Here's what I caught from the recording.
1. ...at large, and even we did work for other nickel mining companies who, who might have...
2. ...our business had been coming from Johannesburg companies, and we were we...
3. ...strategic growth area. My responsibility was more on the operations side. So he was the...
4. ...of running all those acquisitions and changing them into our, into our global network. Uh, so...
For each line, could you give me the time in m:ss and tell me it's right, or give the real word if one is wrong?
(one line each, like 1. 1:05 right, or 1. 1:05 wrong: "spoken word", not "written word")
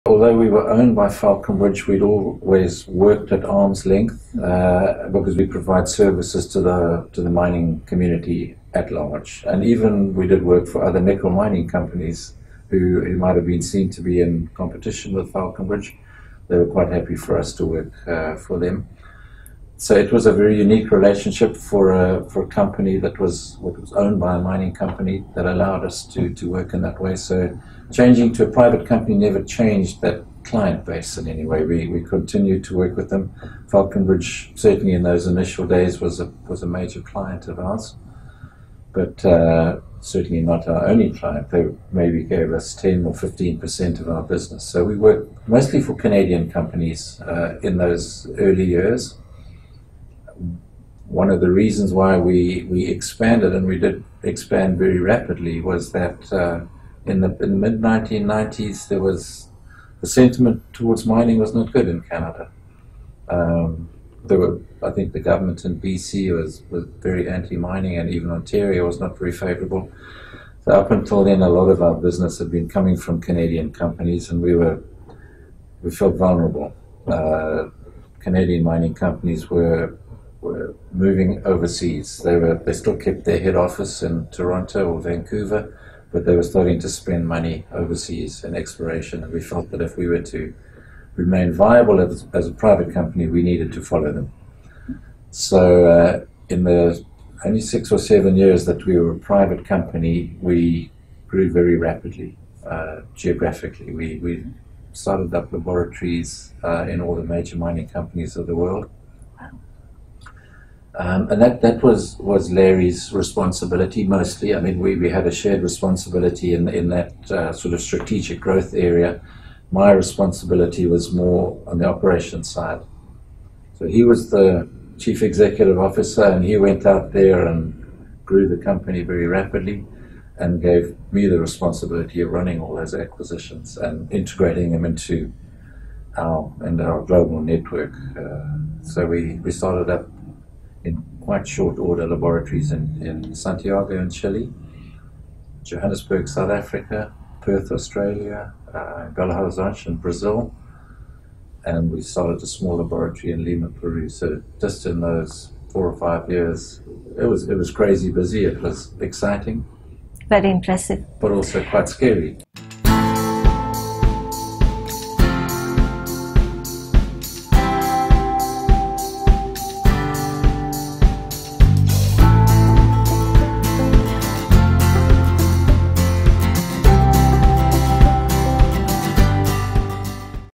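1. 0:08 right
2. 1:11 wrong: "Canadian", not "Johannesburg"
3. 1:57 right
4. 2:12 wrong: "integrating", not "changing".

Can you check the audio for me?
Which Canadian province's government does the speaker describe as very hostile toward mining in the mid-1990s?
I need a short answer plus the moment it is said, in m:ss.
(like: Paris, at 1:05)
BC, at 1:05.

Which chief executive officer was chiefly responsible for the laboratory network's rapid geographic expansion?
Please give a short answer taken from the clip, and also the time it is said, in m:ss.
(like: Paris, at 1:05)
Larry, at 1:52.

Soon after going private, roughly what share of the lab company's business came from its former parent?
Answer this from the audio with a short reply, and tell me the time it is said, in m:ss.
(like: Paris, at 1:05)
10 or 15%, at 0:42.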